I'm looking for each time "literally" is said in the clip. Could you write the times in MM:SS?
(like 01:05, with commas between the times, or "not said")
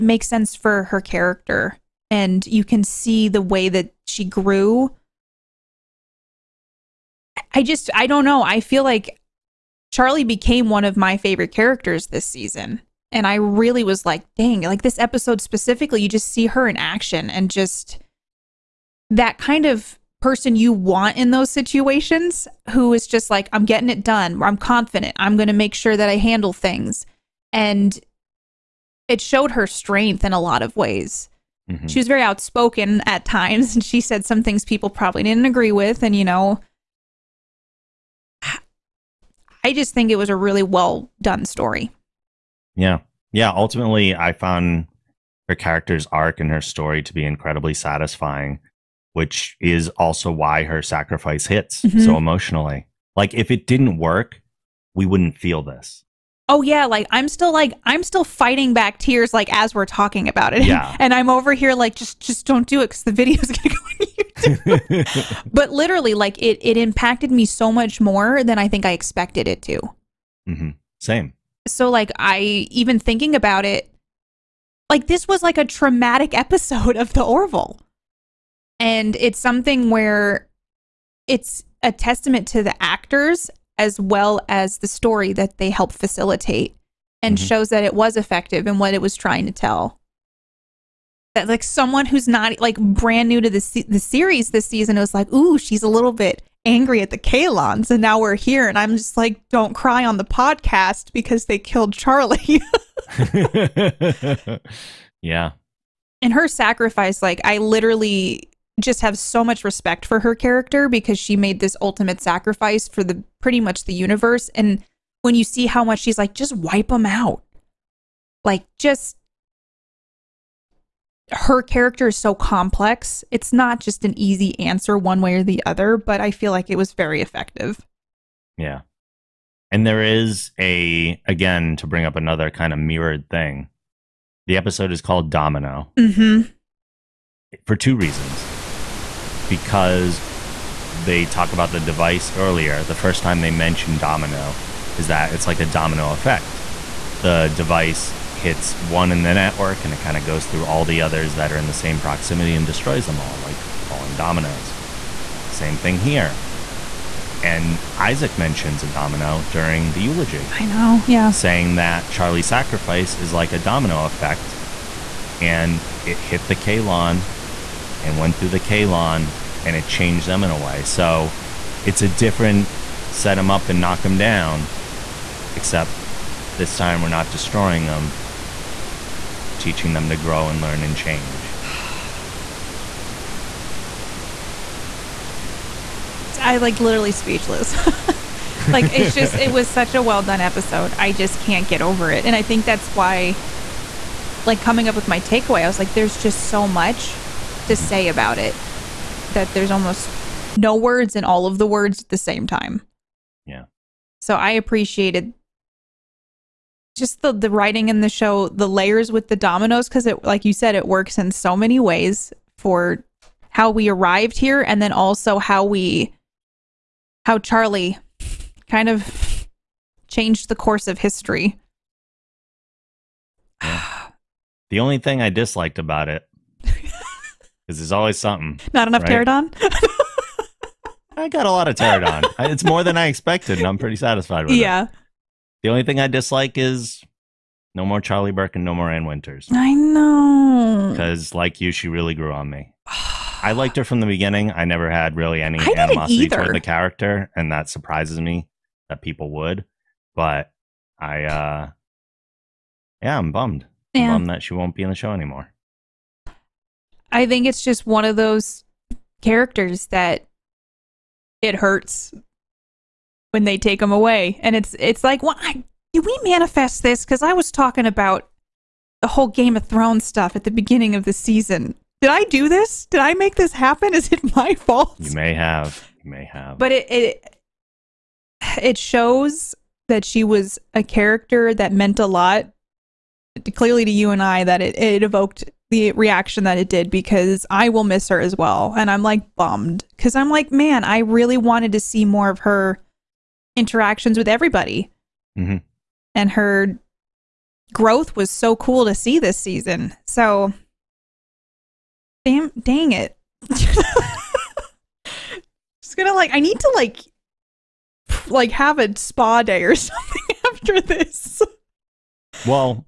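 01:05, 01:47, 03:06.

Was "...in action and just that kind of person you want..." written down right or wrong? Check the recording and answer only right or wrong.
right.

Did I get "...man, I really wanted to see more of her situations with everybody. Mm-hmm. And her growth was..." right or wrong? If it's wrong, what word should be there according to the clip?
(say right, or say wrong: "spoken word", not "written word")
wrong: "interactions", not "situations".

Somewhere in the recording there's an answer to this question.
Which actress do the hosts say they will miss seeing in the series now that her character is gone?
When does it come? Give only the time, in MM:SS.
03:58.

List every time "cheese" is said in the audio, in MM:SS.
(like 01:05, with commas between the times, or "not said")
not said.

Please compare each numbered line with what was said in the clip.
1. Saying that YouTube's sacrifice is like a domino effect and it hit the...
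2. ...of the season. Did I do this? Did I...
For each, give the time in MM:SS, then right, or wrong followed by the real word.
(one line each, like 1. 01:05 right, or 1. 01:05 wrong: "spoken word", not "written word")
1. 02:41 wrong: "Charlie", not "YouTube"
2. 04:30 right.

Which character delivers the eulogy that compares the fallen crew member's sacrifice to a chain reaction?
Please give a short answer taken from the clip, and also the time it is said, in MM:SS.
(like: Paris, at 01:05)
Isaac, at 02:37.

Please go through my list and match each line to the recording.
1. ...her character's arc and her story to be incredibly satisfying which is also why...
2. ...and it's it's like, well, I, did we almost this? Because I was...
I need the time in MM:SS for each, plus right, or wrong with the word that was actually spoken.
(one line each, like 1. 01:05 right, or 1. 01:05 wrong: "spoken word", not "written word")
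1. 00:45 right
2. 04:24 wrong: "manifest", not "almost".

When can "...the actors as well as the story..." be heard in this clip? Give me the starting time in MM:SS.
01:22.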